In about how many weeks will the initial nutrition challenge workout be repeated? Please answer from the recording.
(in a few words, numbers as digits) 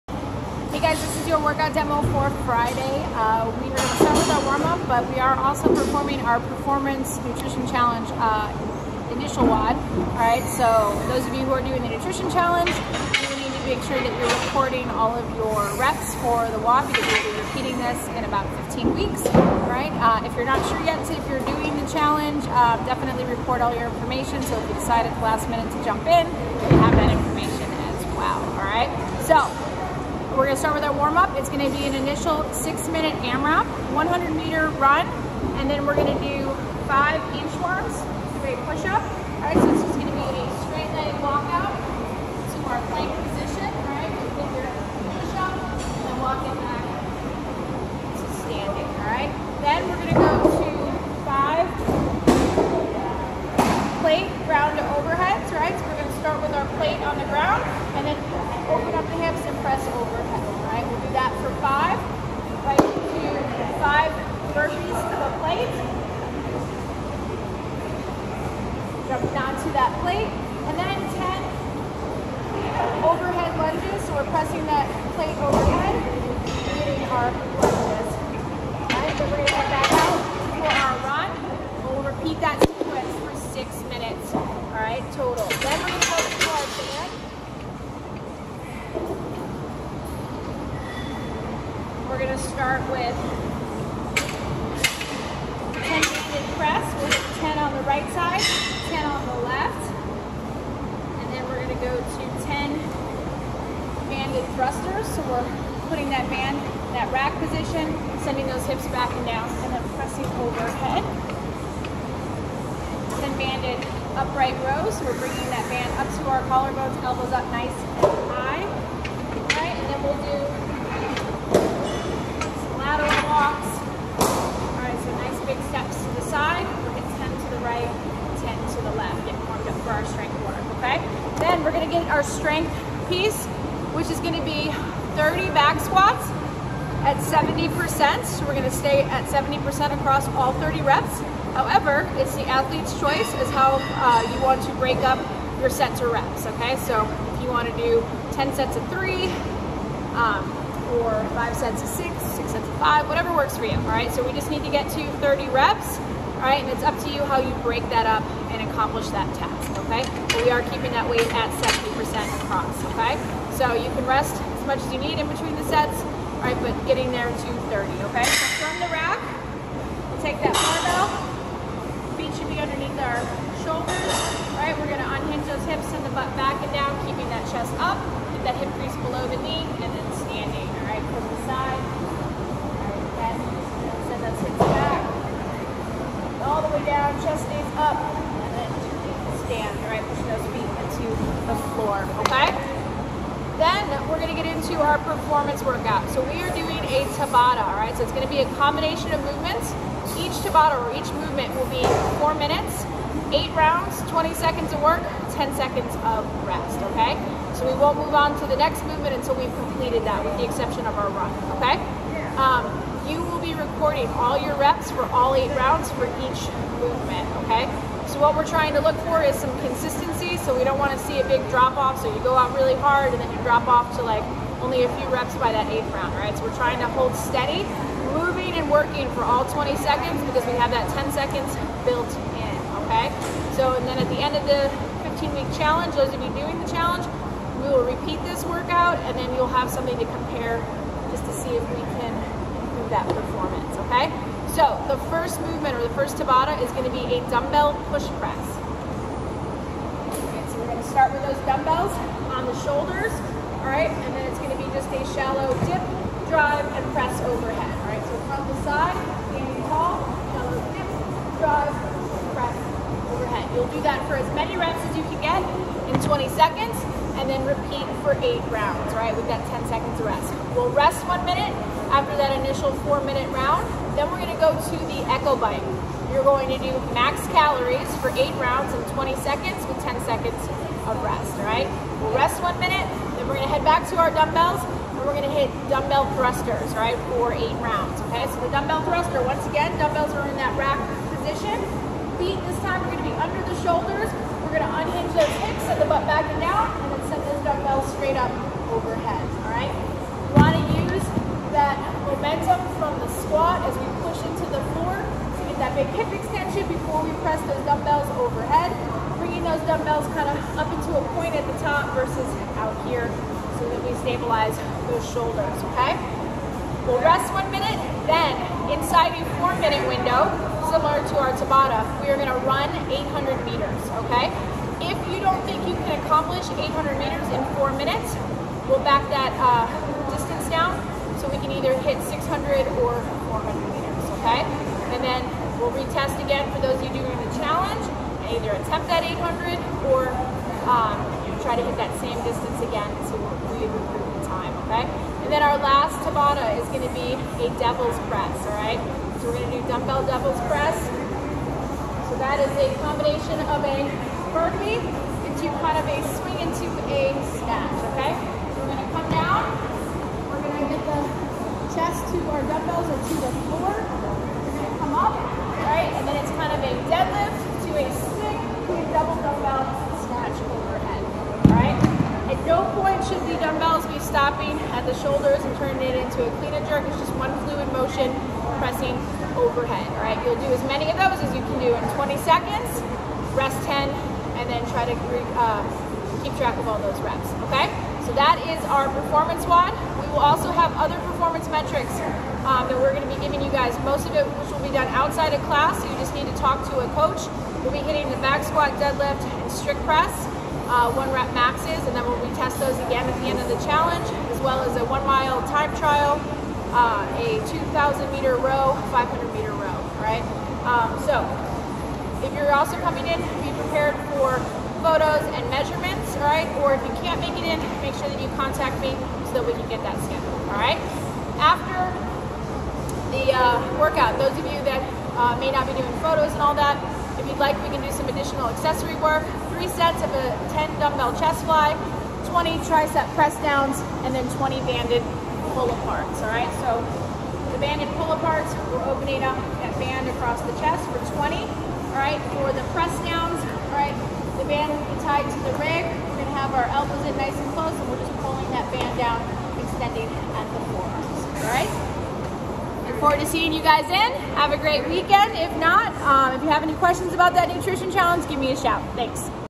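15.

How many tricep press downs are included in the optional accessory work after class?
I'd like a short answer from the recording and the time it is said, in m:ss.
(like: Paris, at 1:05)
20, at 7:12.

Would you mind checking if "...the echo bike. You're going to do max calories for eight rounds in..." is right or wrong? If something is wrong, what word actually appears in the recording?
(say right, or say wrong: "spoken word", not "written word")
right.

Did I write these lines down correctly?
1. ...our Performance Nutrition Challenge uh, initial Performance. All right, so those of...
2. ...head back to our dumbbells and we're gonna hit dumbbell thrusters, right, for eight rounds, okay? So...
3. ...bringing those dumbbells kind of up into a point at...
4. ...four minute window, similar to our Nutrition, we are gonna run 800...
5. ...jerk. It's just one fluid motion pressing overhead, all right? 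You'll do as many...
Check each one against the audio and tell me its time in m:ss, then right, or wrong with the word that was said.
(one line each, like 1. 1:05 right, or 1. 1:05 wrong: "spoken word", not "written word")
1. 0:06 wrong: "WoD", not "Performance"
2. 4:43 right
3. 5:09 right
4. 5:19 wrong: "Tabata", not "Nutrition"
5. 6:16 right.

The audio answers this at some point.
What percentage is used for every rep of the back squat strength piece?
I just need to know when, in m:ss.
2:15.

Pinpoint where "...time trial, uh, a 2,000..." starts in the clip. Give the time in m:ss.
6:45.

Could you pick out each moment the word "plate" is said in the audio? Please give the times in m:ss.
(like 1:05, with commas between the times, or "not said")
1:05, 1:10, 1:15.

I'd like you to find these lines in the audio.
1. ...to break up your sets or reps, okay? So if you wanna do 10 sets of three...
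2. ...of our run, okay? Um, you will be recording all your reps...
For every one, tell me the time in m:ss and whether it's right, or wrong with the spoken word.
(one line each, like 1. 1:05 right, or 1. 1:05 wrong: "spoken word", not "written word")
1. 2:24 right
2. 3:30 right.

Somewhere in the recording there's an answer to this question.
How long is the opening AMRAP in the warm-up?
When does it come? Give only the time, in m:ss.
0:32.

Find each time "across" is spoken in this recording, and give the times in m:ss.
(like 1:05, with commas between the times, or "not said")
2:19, 2:42, 7:20.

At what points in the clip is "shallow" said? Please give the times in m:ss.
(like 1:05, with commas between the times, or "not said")
4:15, 4:20.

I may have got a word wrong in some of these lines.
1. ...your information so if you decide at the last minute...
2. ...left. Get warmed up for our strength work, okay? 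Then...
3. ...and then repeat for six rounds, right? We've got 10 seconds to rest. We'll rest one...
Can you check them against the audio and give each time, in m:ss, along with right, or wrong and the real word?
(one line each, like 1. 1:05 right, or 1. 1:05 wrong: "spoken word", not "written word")
1. 0:23 right
2. 2:08 right
3. 4:27 wrong: "eight", not "six".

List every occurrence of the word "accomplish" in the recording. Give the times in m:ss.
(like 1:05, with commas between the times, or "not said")
2:38, 5:26.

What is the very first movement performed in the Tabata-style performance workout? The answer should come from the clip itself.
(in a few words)
Dumbbell push press.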